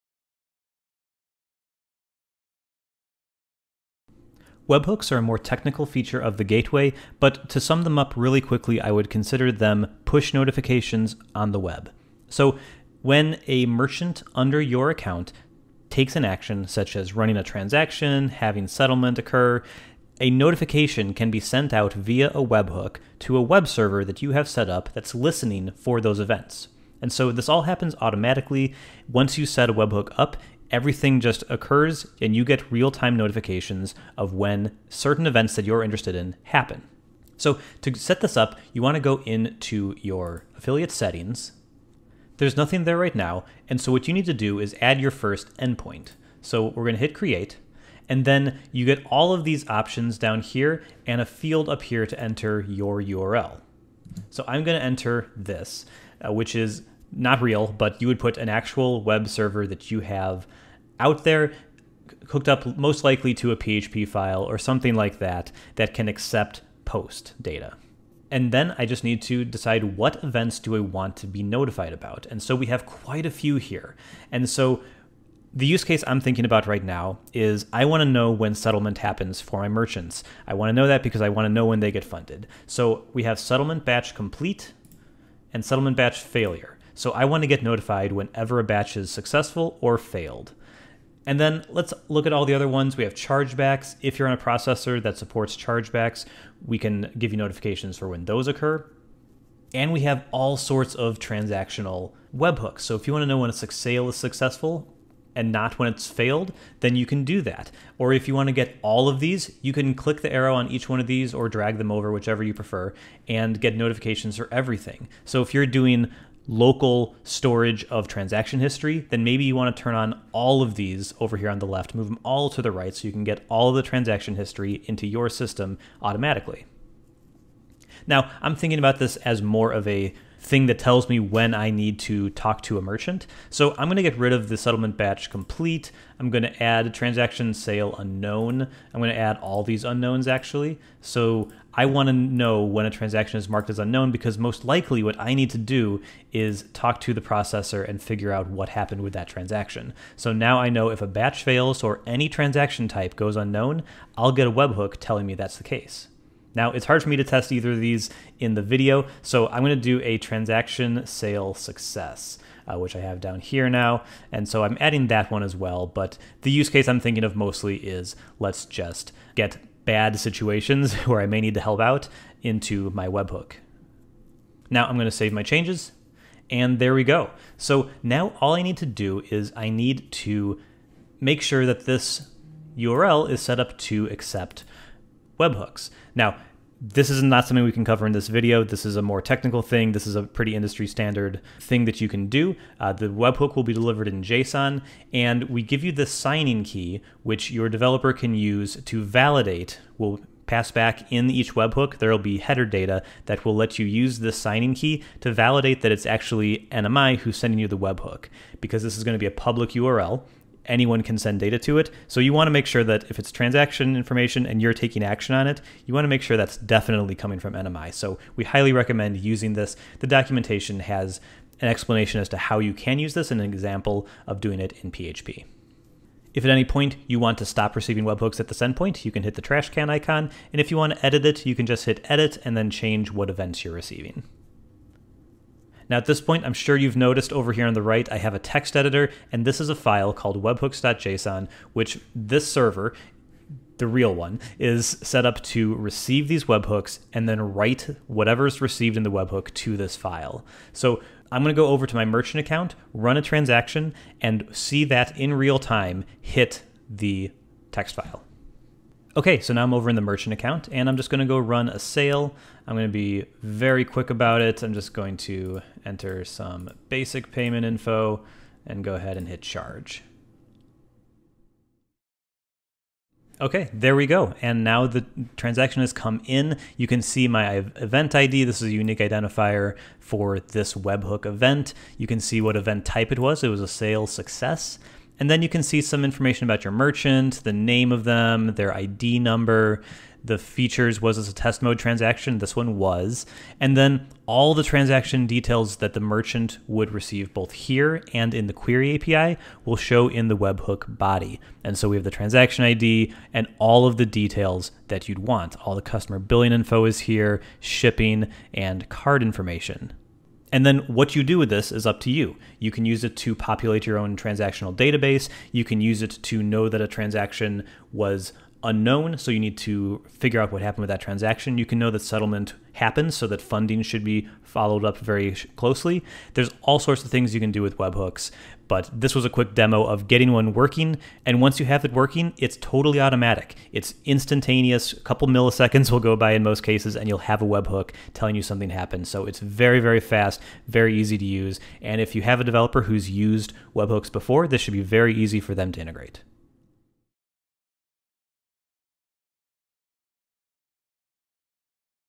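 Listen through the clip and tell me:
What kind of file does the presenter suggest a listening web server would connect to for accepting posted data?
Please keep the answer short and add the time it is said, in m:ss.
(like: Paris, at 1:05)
PHP file, at 1:03.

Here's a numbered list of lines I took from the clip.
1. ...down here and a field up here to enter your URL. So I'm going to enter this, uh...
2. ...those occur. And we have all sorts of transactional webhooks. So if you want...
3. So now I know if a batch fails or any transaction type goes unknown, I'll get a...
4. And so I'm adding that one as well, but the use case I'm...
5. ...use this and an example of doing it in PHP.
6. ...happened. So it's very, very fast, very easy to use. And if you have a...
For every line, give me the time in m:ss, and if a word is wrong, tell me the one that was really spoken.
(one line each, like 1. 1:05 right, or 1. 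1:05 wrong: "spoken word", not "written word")
1. 0:50 right
2. 1:38 right
3. 2:30 right
4. 2:44 right
5. 3:42 right
6. 5:38 right.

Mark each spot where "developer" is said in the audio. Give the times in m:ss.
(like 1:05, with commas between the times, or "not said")
3:17, 5:42.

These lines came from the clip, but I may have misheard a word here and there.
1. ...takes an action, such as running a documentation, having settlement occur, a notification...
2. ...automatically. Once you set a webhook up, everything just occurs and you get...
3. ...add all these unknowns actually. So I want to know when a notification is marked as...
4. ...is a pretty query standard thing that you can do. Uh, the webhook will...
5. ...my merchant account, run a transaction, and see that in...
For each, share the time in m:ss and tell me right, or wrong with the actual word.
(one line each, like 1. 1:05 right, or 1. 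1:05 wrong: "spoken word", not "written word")
1. 0:15 wrong: "transaction", not "documentation"
2. 0:27 right
3. 2:19 wrong: "transaction", not "notification"
4. 3:10 wrong: "industry", not "query"
5. 4:11 right.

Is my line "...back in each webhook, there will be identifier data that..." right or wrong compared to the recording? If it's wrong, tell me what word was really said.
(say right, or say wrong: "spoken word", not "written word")
wrong: "header", not "identifier".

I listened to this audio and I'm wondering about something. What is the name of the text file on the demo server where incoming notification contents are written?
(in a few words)
webhooks.json.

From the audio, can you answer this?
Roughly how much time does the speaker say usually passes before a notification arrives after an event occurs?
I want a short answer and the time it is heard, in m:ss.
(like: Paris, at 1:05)
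A couple milliseconds, at 5:34.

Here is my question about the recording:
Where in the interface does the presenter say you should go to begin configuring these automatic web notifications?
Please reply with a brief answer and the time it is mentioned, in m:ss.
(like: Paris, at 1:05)
Affiliate settings, at 0:40.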